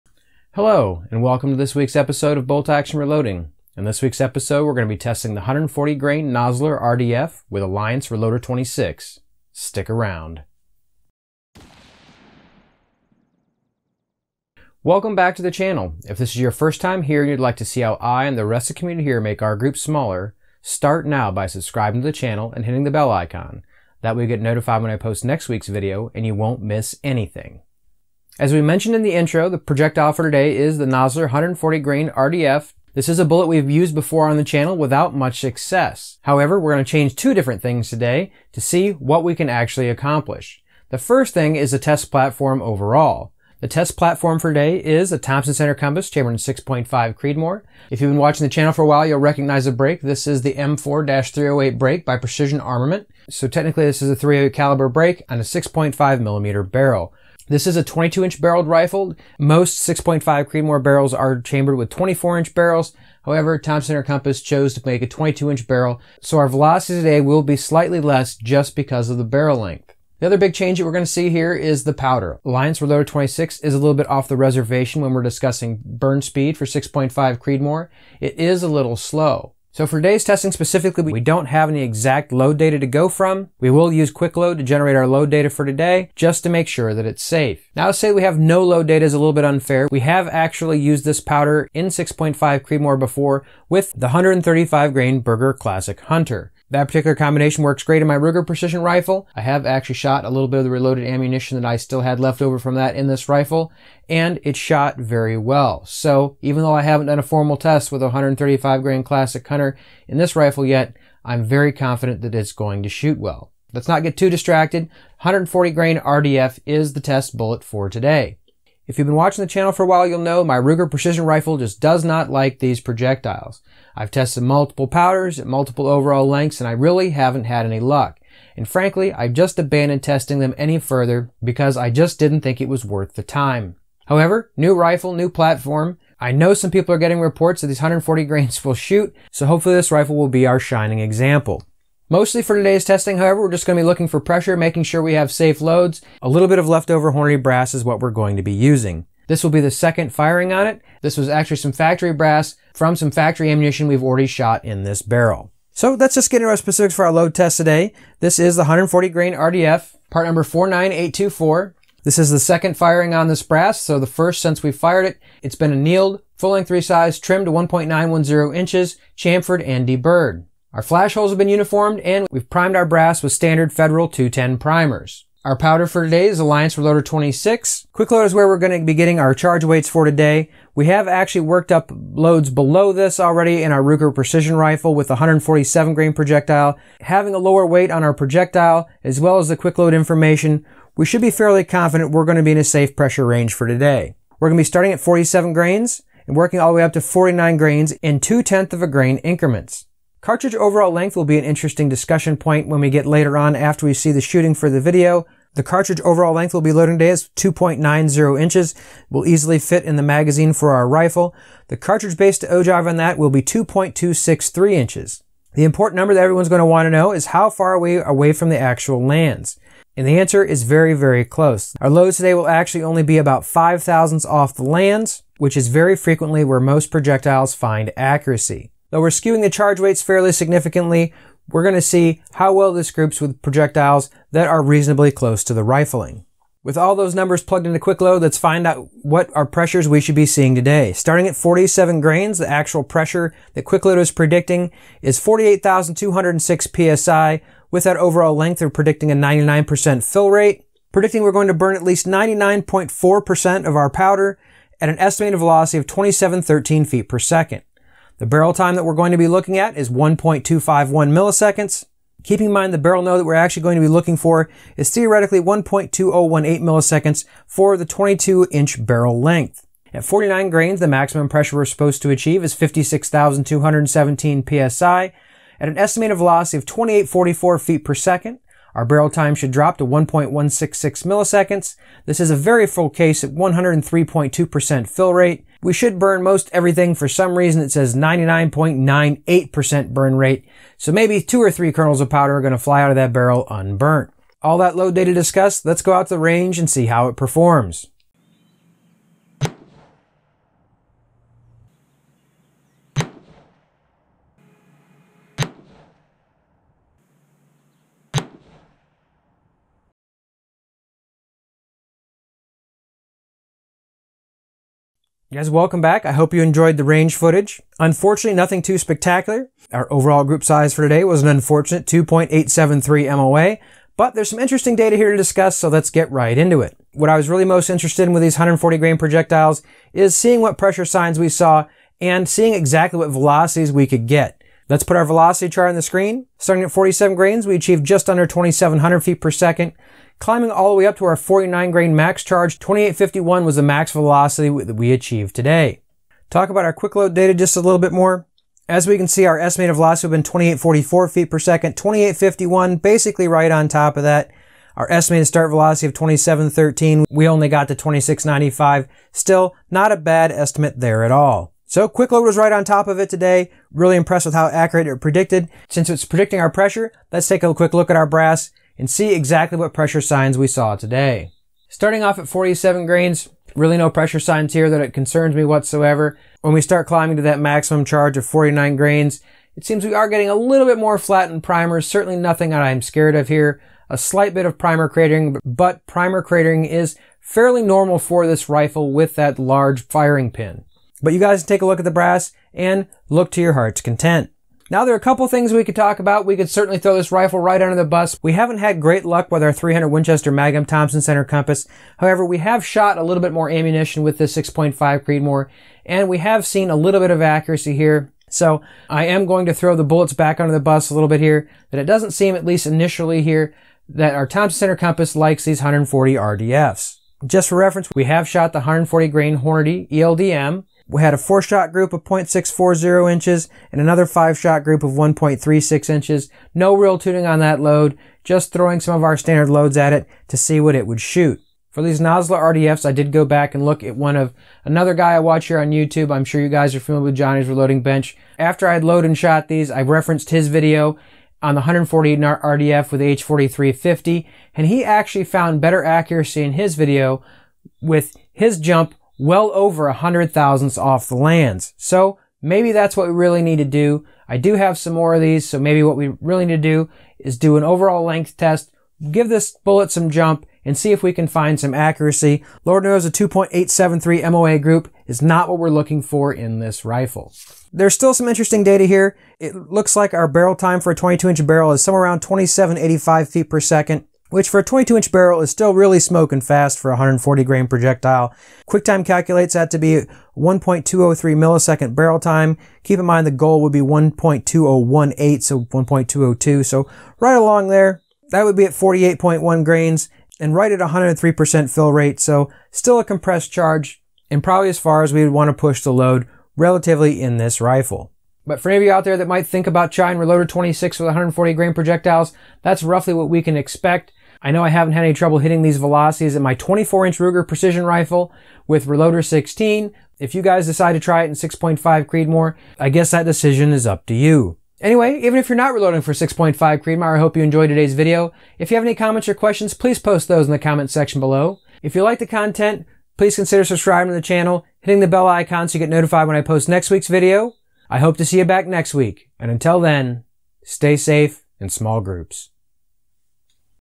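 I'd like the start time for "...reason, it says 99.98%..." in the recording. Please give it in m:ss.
4:47.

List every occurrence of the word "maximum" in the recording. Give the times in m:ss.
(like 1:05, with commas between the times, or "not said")
4:30, 6:17.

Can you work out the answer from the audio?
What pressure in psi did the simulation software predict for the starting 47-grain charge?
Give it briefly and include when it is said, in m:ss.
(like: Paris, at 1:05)
48,206 psi, at 4:05.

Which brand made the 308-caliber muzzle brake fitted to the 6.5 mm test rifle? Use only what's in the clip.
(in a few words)
Precision Armament.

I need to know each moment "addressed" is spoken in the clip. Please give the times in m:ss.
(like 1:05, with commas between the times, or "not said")
not said.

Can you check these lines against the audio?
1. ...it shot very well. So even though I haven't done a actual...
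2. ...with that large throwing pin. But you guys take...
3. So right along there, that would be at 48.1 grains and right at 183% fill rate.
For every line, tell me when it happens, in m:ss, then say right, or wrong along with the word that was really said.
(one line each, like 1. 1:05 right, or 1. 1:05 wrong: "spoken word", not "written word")
1. 1:44 wrong: "formal", not "actual"
2. 6:28 wrong: "firing", not "throwing"
3. 8:06 wrong: "103", not "183".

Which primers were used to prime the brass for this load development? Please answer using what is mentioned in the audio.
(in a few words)
Federal 210.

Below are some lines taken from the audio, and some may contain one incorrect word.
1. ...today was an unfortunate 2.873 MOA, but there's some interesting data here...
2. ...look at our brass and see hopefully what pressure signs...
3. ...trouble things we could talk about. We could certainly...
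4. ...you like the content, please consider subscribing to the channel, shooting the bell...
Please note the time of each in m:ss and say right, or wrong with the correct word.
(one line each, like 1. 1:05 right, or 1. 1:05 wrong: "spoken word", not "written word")
1. 5:20 right
2. 6:07 wrong: "exactly", not "hopefully"
3. 6:35 wrong: "couple", not "trouble"
4. 8:41 wrong: "hitting", not "shooting".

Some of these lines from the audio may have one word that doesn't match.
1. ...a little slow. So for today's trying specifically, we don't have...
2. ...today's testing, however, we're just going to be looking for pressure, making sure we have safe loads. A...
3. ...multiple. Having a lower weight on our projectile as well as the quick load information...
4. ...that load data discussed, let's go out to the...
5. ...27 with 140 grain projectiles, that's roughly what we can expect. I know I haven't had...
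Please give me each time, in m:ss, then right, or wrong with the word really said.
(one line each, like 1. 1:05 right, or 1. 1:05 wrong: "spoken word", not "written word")
1. 1:18 wrong: "testing", not "trying"
2. 2:22 right
3. 3:06 wrong: "projectile", not "multiple"
4. 4:54 right
5. 8:20 wrong: "26", not "27".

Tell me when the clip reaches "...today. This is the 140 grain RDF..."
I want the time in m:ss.
2:37.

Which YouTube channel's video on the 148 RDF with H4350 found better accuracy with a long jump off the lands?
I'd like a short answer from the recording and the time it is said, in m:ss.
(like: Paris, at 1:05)
Johnny's Reloading Bench, at 7:17.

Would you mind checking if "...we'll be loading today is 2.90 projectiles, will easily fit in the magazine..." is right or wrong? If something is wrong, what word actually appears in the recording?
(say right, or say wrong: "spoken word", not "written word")
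wrong: "inches", not "projectiles".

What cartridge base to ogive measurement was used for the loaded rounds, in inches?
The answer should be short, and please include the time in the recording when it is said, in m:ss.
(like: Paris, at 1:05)
2.263 inches, at 3:33.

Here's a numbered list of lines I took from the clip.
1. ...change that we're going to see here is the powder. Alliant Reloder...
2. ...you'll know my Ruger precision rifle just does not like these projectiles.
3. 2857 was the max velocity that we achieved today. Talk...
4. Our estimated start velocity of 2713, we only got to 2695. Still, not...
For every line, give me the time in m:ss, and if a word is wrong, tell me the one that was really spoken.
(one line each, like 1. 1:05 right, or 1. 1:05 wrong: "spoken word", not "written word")
1. 1:10 right
2. 2:00 right
3. 5:42 wrong: "2851", not "2857"
4. 5:54 right.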